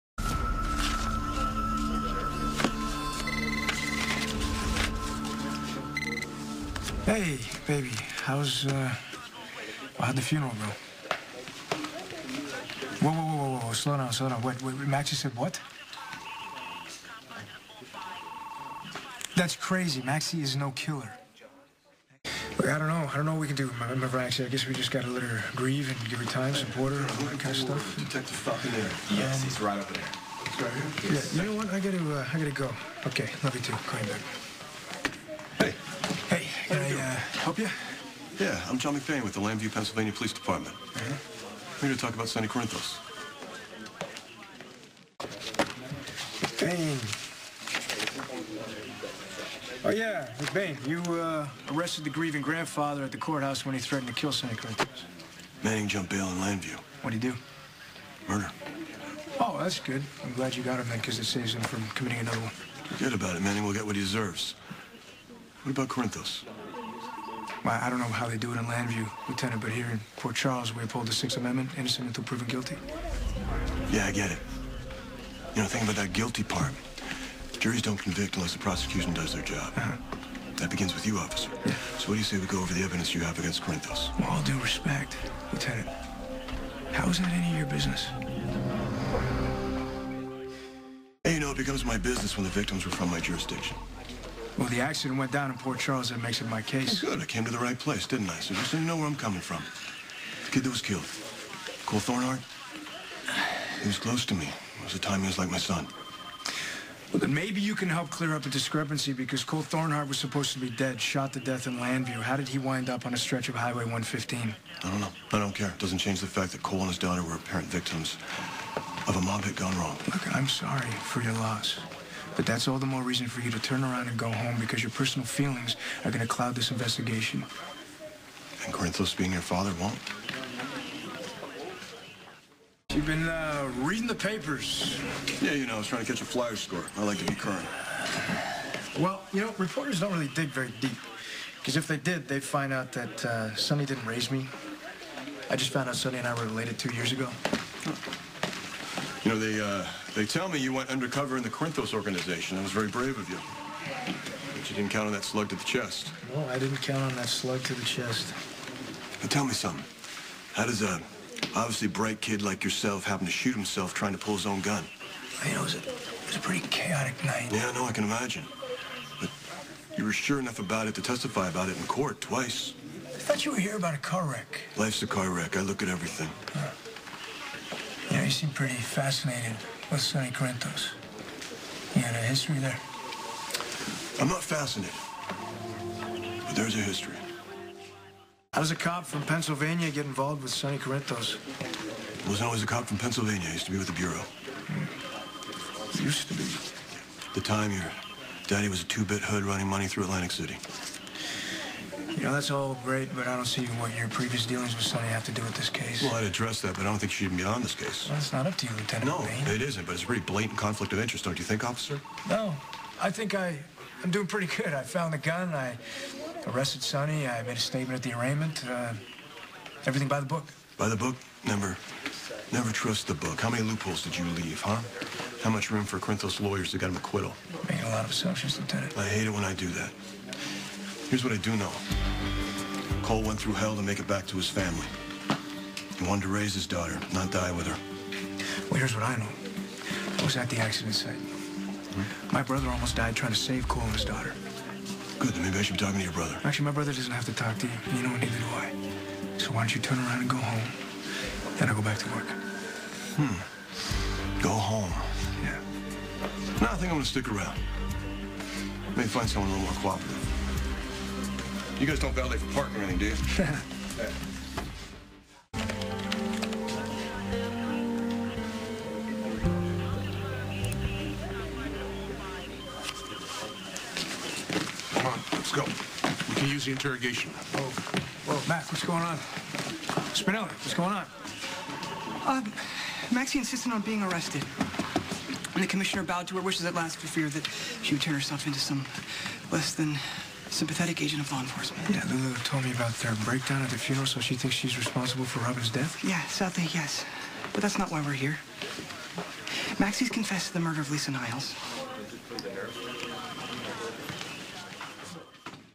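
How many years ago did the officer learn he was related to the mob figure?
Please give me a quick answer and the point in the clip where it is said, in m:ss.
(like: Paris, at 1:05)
2, at 2:26.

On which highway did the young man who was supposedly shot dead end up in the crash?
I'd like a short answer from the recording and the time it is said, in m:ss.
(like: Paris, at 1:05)
Highway 115, at 1:53.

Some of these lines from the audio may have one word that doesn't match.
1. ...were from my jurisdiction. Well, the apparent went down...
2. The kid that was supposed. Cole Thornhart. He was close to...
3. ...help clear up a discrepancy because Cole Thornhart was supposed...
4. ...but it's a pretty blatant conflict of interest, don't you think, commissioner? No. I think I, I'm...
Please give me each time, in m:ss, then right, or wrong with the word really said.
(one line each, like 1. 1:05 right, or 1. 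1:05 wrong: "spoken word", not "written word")
1. 1:32 wrong: "accident", not "apparent"
2. 1:40 wrong: "killed", not "supposed"
3. 1:47 right
4. 3:29 wrong: "officer", not "commissioner".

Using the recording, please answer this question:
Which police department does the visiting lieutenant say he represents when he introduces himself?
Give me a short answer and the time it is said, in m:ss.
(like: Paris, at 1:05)
Llanview, Pennsylvania, at 0:39.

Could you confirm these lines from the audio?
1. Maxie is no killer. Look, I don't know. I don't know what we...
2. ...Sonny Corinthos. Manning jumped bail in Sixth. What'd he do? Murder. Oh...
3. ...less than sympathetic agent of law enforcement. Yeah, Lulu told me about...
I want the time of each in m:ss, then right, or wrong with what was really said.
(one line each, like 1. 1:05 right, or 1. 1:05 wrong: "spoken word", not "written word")
1. 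0:20 right
2. 0:54 wrong: "Llanview", not "Sixth"
3. 4:49 right.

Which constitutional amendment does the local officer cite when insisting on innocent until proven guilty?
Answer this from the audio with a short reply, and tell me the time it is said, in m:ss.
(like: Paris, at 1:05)
Sixth Amendment, at 1:11.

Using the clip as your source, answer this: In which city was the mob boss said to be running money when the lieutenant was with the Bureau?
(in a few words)
Atlantic City.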